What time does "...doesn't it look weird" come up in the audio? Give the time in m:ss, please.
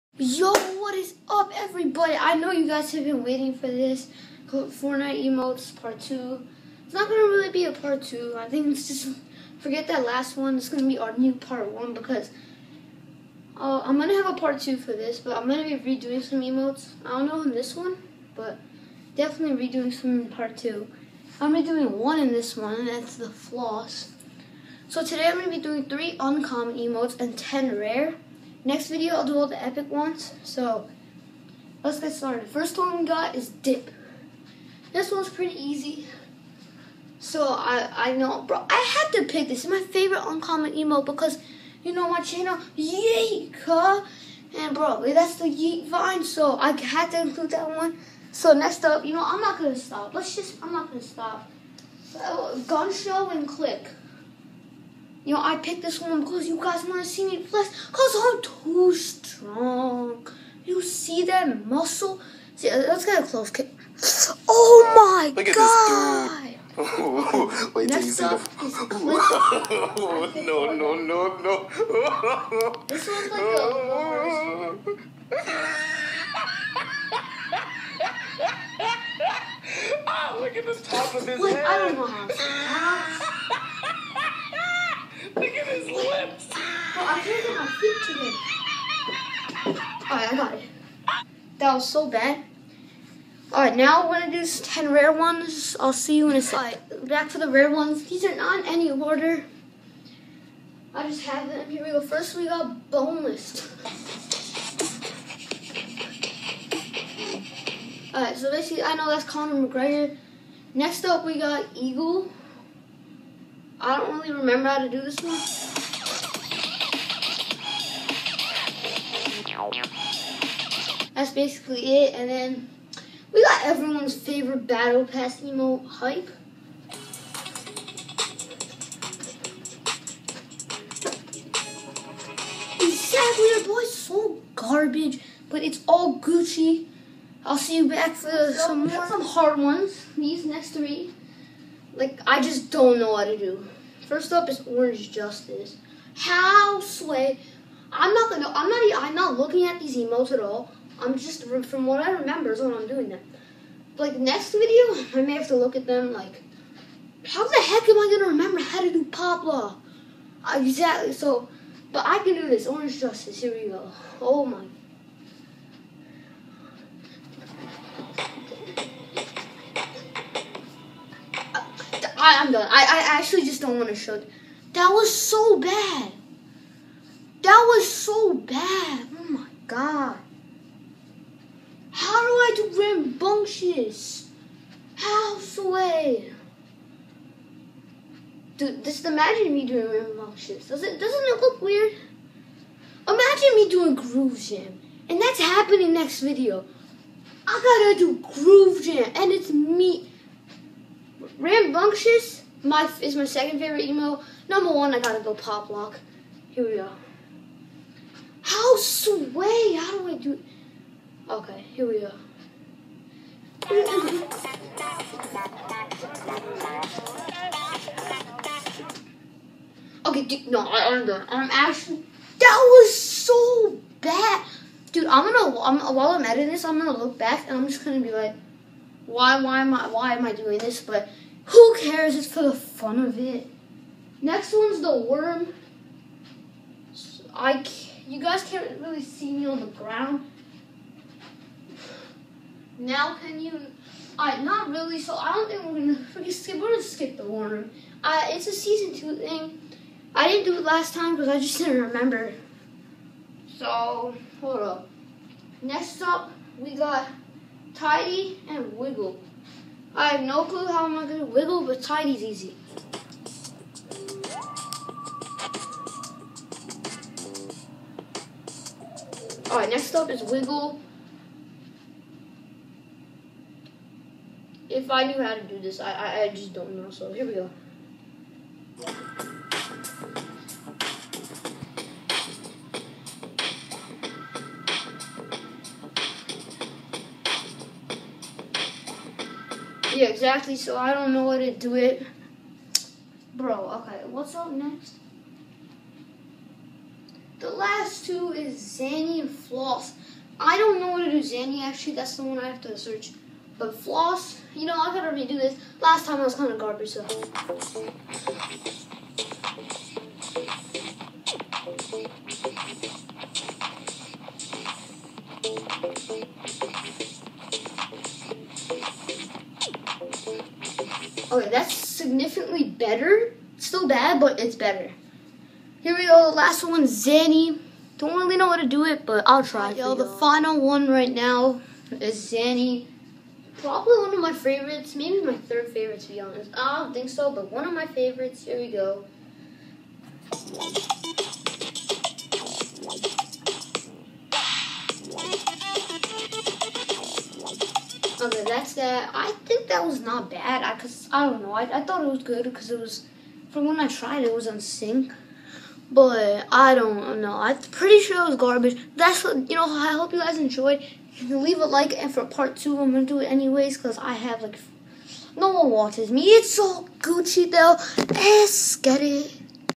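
3:10.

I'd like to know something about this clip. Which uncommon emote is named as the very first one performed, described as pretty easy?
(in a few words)
Dip.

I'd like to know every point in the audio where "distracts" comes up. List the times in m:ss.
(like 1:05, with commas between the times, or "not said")
not said.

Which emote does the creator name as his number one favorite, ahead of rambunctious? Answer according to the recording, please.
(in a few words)
Pop lock.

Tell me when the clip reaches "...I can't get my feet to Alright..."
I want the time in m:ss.
1:27.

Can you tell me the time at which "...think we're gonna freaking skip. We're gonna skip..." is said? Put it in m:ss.
4:05.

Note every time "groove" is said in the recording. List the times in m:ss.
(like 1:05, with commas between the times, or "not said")
3:13, 3:18.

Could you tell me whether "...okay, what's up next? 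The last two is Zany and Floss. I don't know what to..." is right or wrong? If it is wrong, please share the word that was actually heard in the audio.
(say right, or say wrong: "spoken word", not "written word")
right.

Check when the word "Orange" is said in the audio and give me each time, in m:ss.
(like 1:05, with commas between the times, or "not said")
2:24, 2:42.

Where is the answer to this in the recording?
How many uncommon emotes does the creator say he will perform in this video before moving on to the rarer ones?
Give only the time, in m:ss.
0:25.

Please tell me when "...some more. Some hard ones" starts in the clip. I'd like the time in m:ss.
2:18.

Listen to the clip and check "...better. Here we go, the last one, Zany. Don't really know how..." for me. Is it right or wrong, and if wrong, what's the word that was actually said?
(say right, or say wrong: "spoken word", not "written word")
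right.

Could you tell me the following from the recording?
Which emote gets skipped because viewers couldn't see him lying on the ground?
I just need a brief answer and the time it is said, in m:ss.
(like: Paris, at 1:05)
The worm, at 3:54.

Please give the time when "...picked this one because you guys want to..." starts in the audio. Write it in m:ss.
0:55.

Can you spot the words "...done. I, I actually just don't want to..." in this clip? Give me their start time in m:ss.
2:52.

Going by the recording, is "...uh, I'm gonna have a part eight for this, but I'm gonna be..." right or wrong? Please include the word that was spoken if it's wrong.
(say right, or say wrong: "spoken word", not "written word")
wrong: "two", not "eight".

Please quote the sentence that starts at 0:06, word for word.
It's not gonna really be a part two.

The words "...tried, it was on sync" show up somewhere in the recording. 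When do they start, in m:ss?
5:53.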